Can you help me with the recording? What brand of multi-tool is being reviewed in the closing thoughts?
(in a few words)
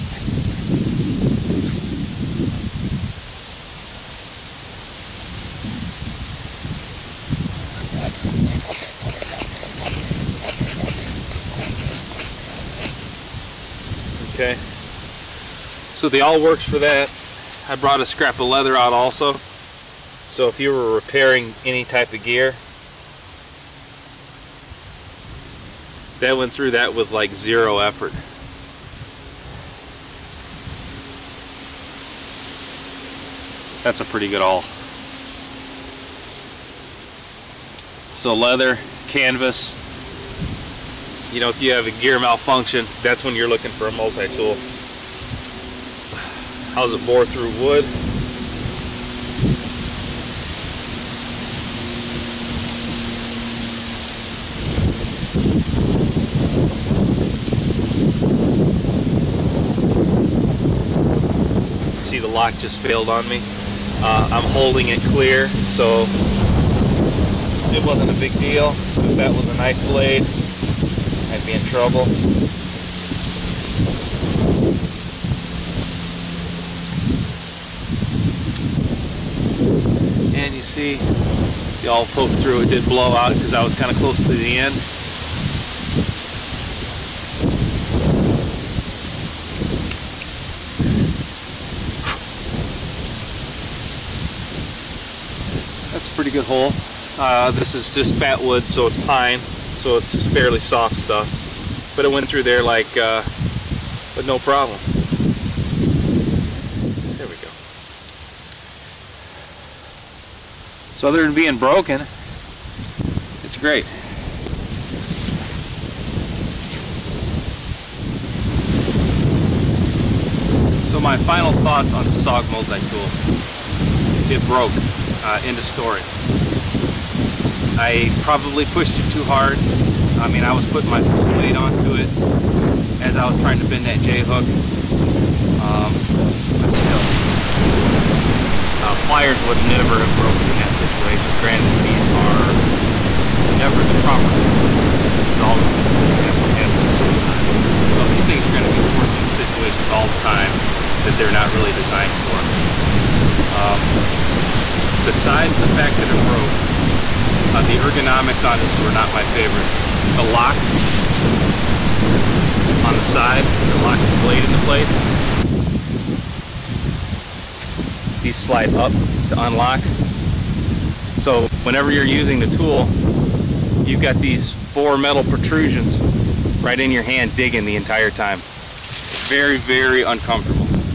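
SOG.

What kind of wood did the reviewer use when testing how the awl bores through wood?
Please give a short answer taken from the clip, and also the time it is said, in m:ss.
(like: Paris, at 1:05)
Fat wood, at 1:38.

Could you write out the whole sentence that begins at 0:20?
So if you were repairing any type of gear, that went through that with like zero effort.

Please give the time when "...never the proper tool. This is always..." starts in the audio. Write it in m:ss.
2:23.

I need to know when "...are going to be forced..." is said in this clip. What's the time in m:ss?
2:28.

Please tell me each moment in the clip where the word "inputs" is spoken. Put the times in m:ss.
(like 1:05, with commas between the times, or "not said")
not said.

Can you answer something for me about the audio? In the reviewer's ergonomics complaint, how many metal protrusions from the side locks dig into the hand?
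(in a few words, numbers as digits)
4.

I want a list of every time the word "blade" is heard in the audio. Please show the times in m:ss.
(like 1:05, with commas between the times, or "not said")
1:09, 2:44.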